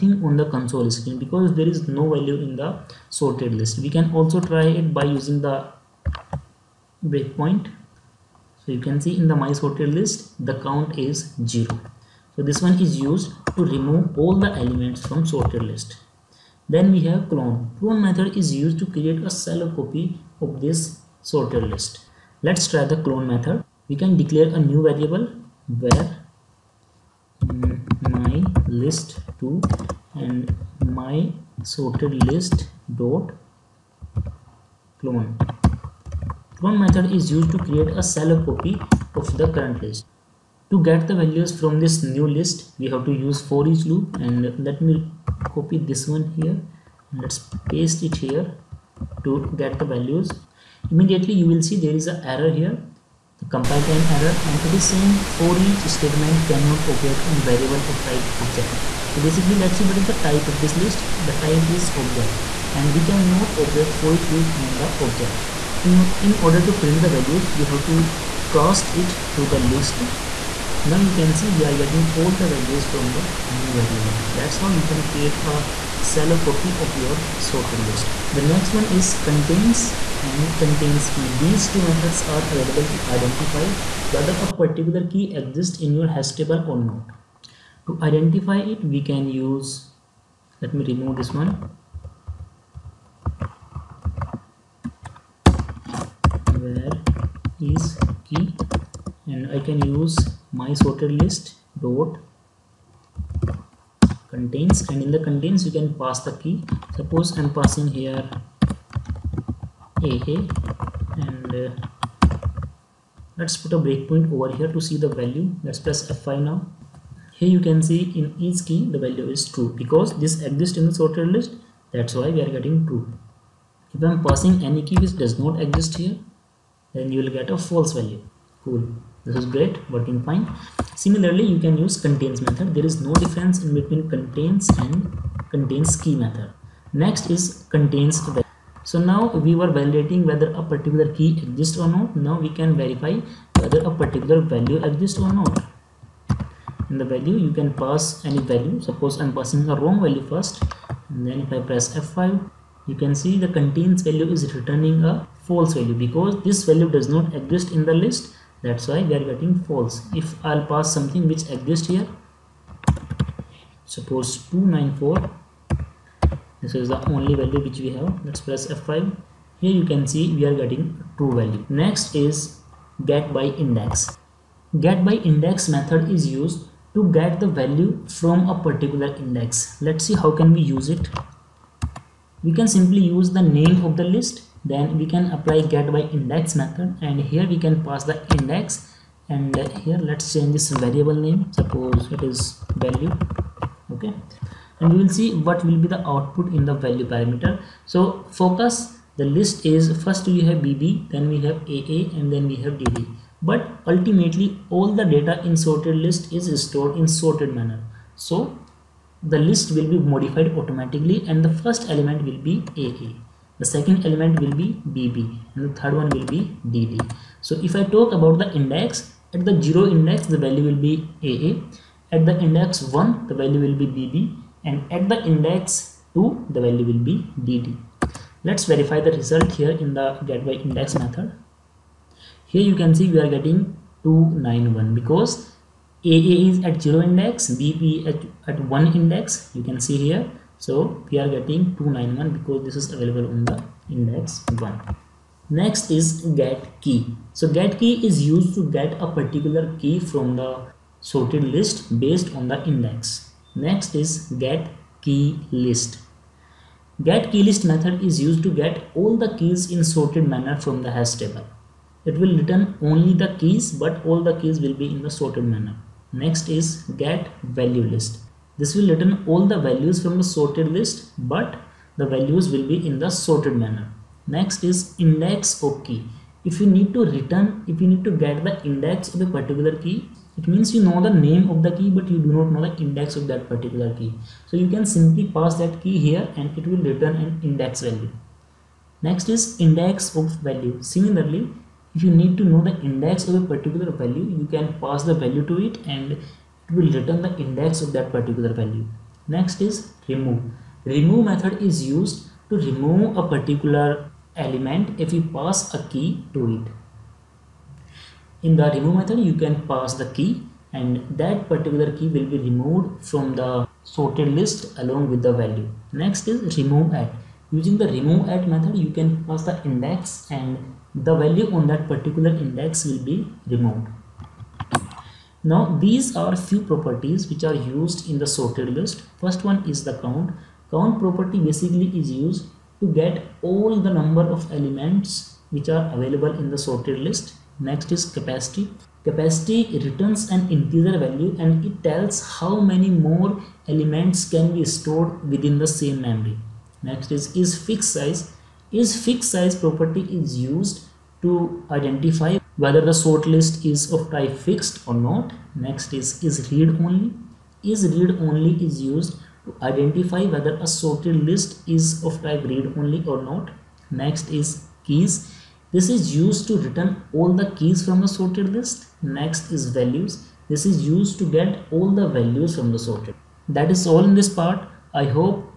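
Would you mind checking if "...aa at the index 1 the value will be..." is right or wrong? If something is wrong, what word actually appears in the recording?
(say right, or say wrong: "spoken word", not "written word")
right.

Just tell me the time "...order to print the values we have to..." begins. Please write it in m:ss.
1:06.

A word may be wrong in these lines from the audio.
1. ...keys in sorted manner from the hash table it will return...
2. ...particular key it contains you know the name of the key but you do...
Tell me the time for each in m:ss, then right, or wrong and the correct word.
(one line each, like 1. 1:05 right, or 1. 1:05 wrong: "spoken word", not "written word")
1. 4:19 right
2. 4:39 wrong: "means", not "contains".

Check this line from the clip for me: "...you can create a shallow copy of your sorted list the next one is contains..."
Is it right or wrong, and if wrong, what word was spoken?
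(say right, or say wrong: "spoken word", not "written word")
right.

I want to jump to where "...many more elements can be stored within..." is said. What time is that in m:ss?
5:42.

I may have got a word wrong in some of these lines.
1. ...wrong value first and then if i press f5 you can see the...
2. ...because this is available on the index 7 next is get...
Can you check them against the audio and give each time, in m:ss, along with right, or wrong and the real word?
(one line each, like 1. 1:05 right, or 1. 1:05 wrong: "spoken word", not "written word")
1. 2:29 right
2. 4:02 wrong: "1", not "7".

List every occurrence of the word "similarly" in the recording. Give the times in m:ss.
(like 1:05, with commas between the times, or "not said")
2:11, 4:50.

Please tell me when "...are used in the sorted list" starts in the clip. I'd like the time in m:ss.
5:27.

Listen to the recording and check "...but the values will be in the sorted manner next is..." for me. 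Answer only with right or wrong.
right.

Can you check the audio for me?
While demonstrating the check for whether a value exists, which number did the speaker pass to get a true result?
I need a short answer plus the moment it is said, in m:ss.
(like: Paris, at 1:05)
294, at 2:44.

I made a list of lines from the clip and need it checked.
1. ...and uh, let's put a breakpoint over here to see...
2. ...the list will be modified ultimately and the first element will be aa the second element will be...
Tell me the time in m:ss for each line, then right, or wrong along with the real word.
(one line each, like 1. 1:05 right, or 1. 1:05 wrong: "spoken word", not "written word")
1. 1:50 right
2. 3:29 wrong: "automatically", not "ultimately".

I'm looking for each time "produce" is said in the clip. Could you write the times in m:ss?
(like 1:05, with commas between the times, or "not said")
not said.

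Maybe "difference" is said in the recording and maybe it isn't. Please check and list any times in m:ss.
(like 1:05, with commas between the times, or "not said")
2:13.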